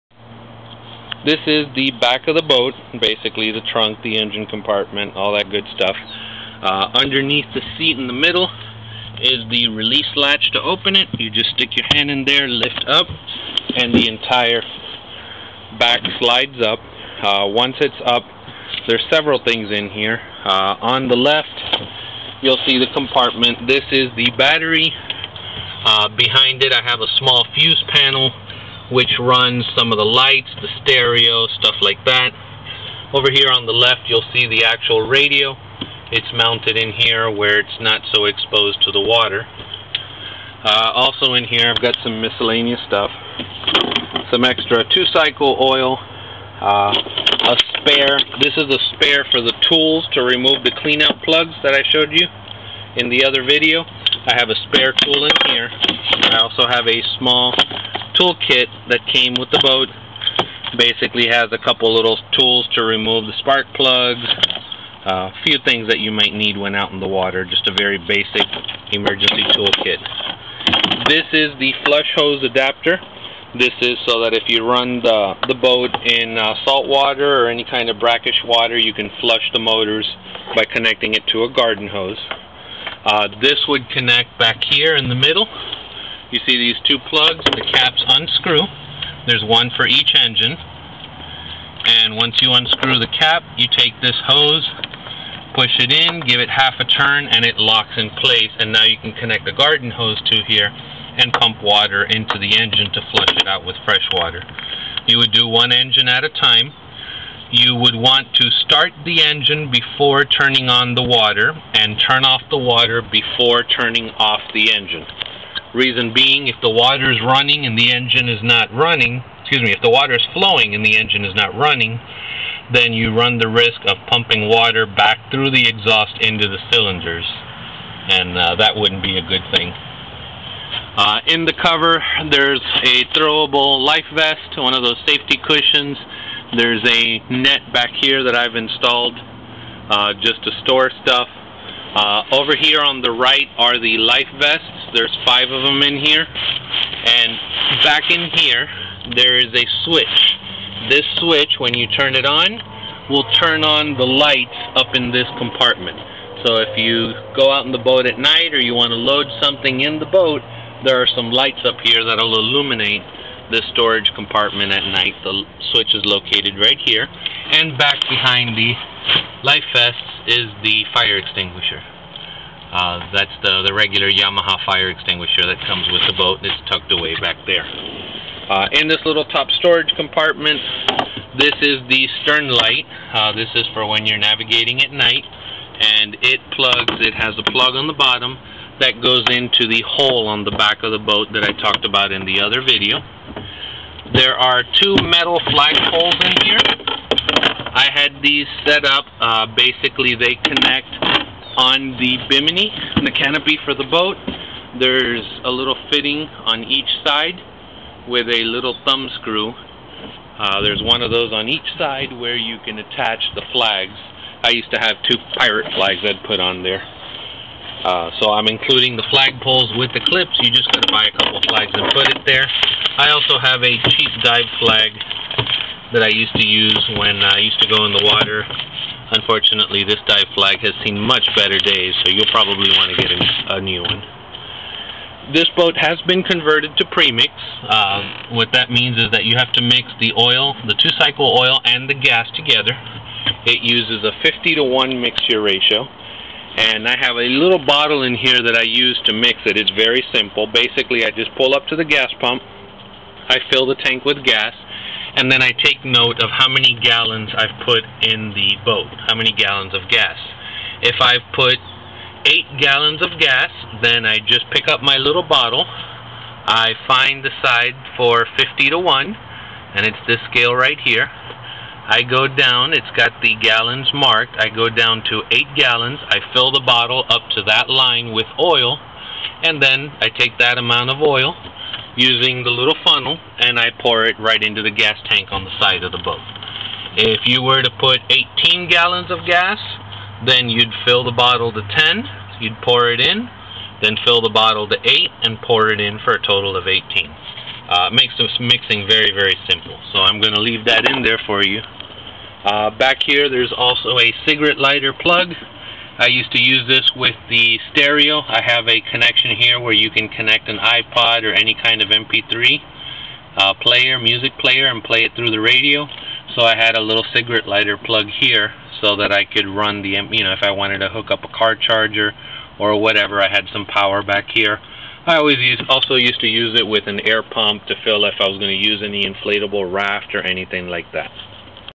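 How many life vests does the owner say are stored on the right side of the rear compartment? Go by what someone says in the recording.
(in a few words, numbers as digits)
5.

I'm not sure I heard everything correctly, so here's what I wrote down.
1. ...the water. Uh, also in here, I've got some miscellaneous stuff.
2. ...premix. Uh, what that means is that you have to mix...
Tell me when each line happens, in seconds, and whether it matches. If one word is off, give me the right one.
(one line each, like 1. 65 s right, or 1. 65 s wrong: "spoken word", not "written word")
1. 38 s right
2. 236 s right.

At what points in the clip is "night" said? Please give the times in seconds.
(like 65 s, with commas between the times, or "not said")
158 s, 164 s, 184 s.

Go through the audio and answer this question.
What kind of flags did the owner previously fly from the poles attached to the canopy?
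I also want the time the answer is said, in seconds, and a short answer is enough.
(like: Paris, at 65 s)
pirate flags, at 215 s.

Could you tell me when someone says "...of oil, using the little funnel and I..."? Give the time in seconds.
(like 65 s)
280 s.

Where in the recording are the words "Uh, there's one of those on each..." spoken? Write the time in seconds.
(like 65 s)
210 s.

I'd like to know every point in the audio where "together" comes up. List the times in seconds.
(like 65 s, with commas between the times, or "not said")
242 s.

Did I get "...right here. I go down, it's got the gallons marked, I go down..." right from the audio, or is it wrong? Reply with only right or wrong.
right.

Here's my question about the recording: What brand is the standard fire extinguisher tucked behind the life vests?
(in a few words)
Yamaha.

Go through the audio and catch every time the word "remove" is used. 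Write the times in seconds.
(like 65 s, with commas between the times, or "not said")
50 s, 62 s.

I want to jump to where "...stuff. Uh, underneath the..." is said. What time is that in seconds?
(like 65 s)
5 s.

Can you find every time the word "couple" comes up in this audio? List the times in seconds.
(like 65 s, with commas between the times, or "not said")
61 s, 221 s.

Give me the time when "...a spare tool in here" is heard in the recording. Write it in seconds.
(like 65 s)
54 s.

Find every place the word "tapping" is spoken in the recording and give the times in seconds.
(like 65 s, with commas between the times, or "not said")
not said.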